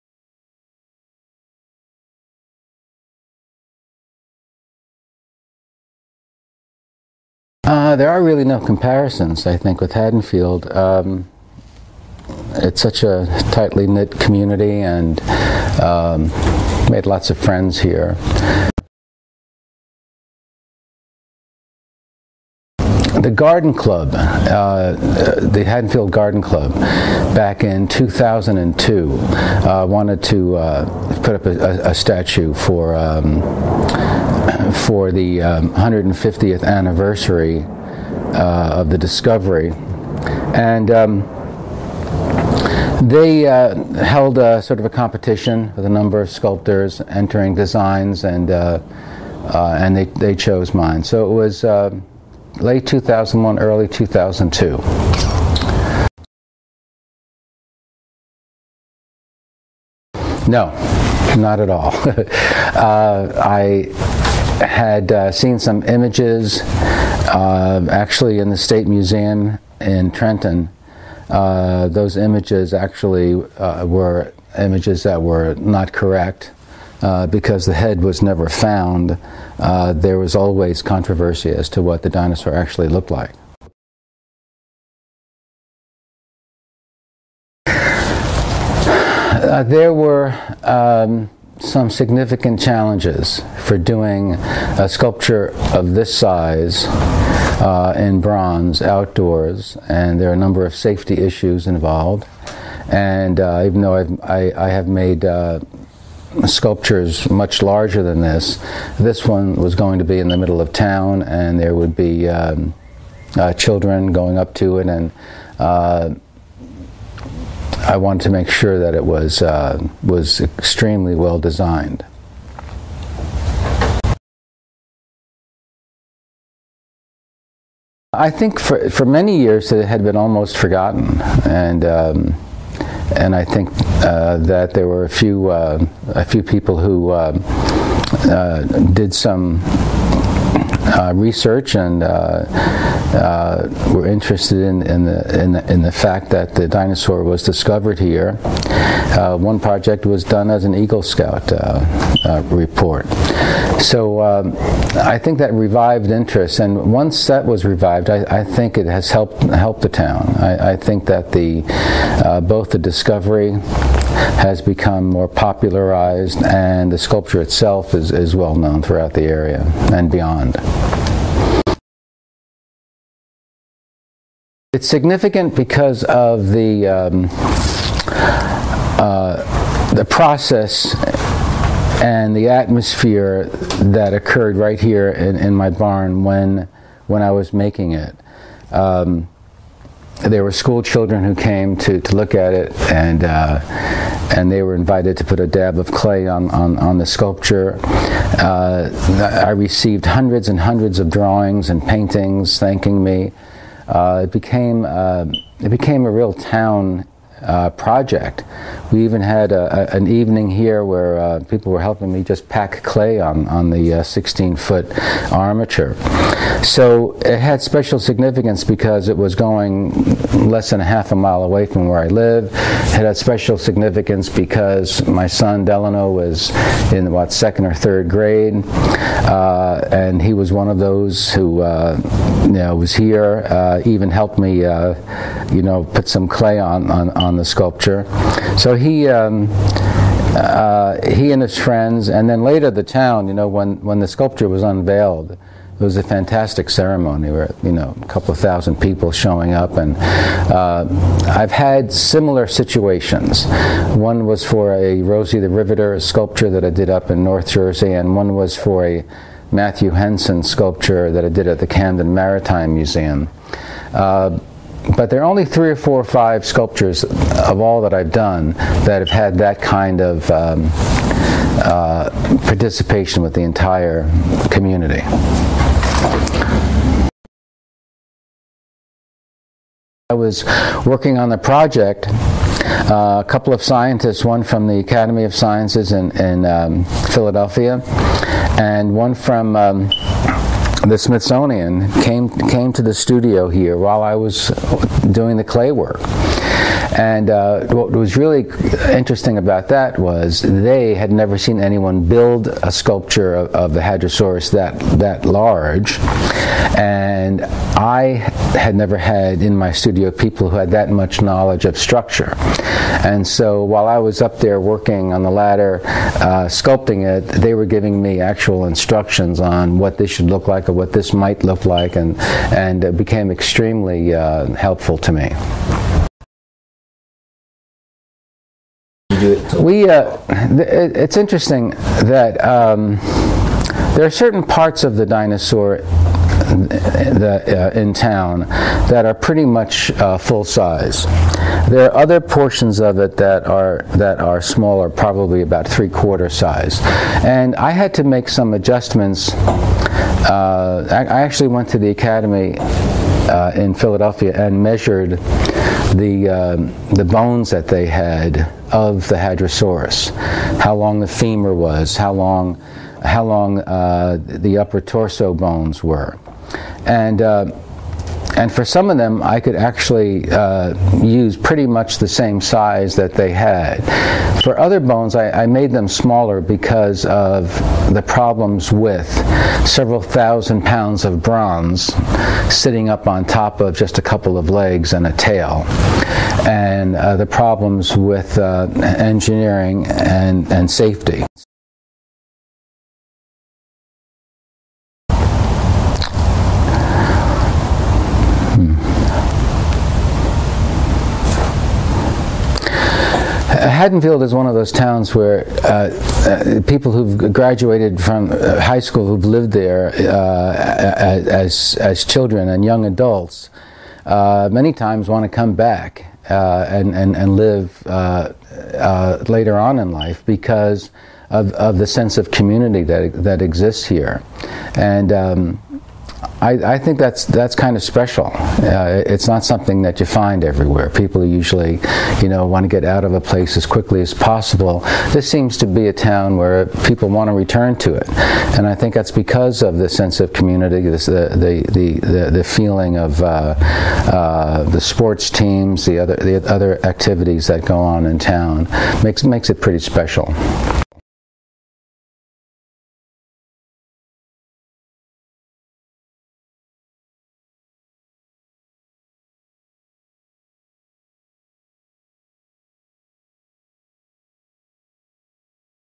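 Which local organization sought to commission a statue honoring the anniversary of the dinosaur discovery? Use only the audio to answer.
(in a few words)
Haddonfield Garden Club.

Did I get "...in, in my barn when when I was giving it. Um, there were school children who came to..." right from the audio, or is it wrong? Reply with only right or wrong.
wrong.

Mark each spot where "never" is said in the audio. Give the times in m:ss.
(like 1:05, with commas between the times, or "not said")
1:18, 5:01, 5:08.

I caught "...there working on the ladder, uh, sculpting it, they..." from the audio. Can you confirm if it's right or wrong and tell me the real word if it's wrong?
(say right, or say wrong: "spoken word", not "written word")
right.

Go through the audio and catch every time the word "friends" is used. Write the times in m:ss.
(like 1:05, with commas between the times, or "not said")
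0:17, 4:01.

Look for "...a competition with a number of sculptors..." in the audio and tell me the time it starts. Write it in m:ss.
0:44.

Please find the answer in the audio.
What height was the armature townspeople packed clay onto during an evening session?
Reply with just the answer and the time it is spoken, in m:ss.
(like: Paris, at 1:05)
16-foot, at 3:33.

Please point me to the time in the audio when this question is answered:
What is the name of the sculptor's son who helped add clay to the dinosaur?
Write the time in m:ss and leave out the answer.
3:45.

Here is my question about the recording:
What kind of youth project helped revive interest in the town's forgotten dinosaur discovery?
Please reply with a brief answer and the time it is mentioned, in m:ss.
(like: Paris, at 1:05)
Eagle Scout report, at 2:30.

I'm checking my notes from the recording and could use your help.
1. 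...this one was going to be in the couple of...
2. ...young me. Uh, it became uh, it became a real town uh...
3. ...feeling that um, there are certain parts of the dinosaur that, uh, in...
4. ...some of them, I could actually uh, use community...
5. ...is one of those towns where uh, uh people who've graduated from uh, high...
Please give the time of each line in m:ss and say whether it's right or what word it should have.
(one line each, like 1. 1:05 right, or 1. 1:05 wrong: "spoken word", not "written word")
1. 1:48 wrong: "middle", not "couple"
2. 3:22 wrong: "thanking", not "young"
3. 5:31 wrong: "interesting", not "feeling"
4. 6:08 wrong: "pretty", not "community"
5. 6:44 right.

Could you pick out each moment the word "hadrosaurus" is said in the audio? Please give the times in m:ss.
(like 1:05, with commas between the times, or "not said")
5:03, 5:59.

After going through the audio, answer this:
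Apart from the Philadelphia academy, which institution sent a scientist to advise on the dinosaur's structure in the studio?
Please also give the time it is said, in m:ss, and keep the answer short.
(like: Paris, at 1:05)
Smithsonian, at 4:50.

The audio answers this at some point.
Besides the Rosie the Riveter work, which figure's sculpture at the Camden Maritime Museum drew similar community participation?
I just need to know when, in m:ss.
4:19.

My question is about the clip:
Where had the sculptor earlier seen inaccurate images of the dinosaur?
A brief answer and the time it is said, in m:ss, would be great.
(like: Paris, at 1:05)
State Museum in Trenton, at 1:08.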